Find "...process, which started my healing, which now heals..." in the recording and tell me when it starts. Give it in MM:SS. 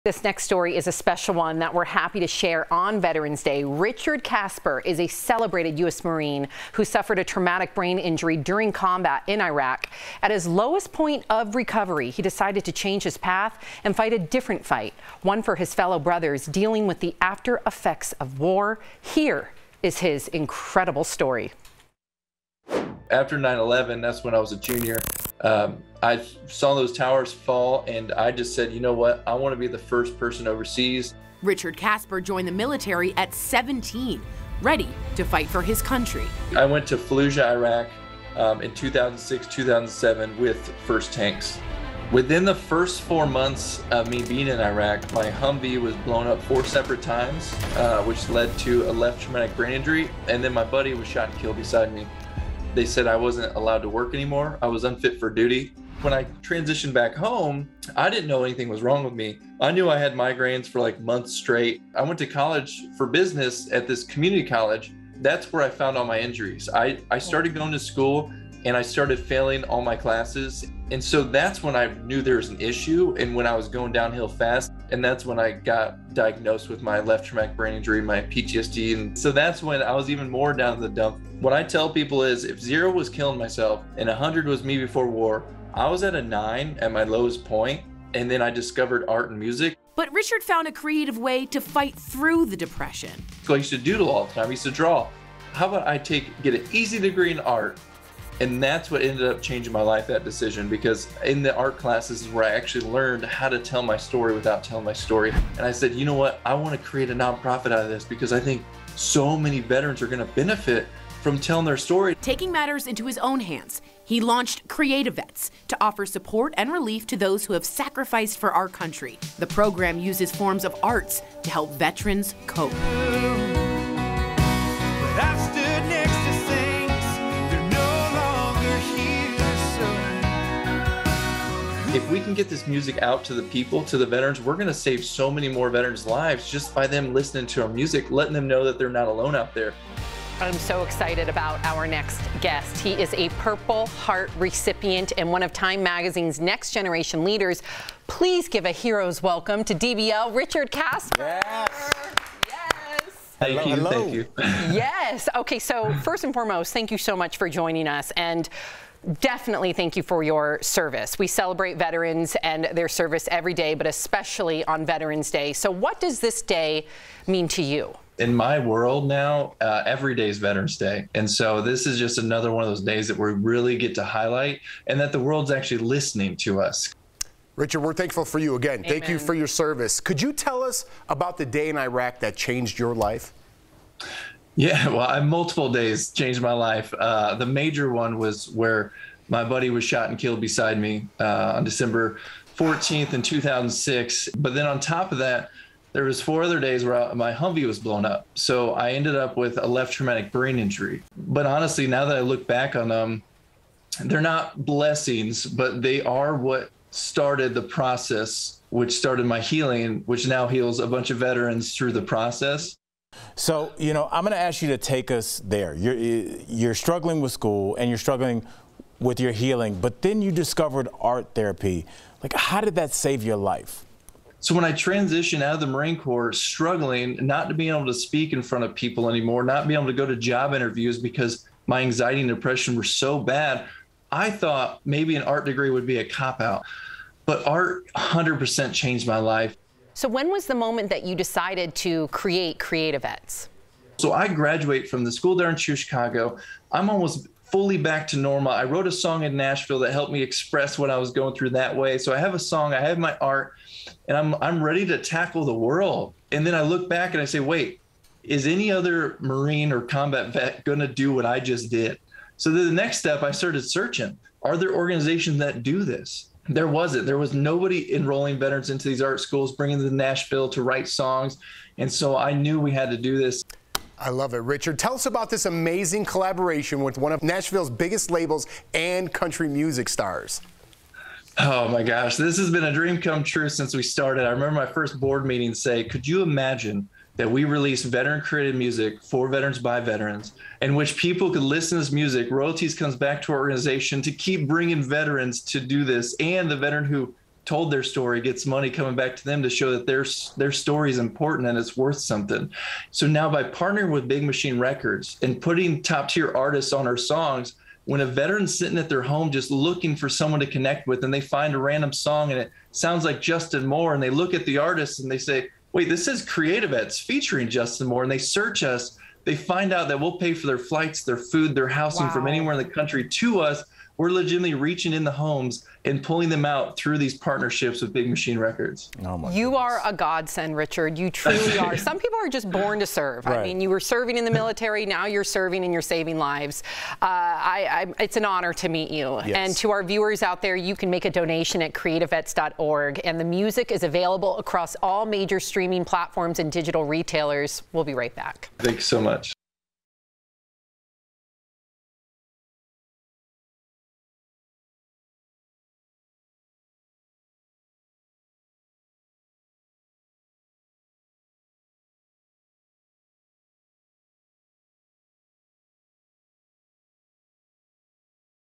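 03:27.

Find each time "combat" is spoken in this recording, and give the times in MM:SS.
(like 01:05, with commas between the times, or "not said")
00:08, 04:19.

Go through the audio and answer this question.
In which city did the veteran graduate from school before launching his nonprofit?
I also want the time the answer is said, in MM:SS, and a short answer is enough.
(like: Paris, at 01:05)
Chicago, at 04:05.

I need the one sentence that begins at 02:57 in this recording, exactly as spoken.
Richard, we're thankful for you again.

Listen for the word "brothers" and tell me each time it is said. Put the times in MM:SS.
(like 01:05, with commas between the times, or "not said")
00:15.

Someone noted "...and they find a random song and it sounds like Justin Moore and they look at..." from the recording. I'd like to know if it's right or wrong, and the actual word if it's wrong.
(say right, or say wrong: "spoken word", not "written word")
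right.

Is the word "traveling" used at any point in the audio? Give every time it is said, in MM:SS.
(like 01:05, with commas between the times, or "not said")
not said.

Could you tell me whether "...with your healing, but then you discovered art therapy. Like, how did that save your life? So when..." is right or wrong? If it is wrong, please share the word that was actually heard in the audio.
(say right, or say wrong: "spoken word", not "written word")
right.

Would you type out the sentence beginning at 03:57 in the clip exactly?
But art 100% changed my life.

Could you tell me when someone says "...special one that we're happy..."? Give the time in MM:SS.
00:00.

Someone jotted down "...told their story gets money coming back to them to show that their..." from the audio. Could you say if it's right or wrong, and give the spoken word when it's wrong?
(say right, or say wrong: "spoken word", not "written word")
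right.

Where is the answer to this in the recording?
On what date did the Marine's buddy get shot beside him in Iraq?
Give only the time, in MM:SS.
03:11.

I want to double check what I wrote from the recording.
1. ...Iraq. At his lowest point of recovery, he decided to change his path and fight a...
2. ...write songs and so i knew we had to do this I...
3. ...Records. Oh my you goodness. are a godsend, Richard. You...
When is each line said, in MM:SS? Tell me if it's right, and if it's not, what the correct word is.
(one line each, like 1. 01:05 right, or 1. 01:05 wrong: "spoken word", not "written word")
1. 00:09 right
2. 04:30 right
3. 05:28 right.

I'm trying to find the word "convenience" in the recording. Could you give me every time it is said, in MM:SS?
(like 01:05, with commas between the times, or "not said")
not said.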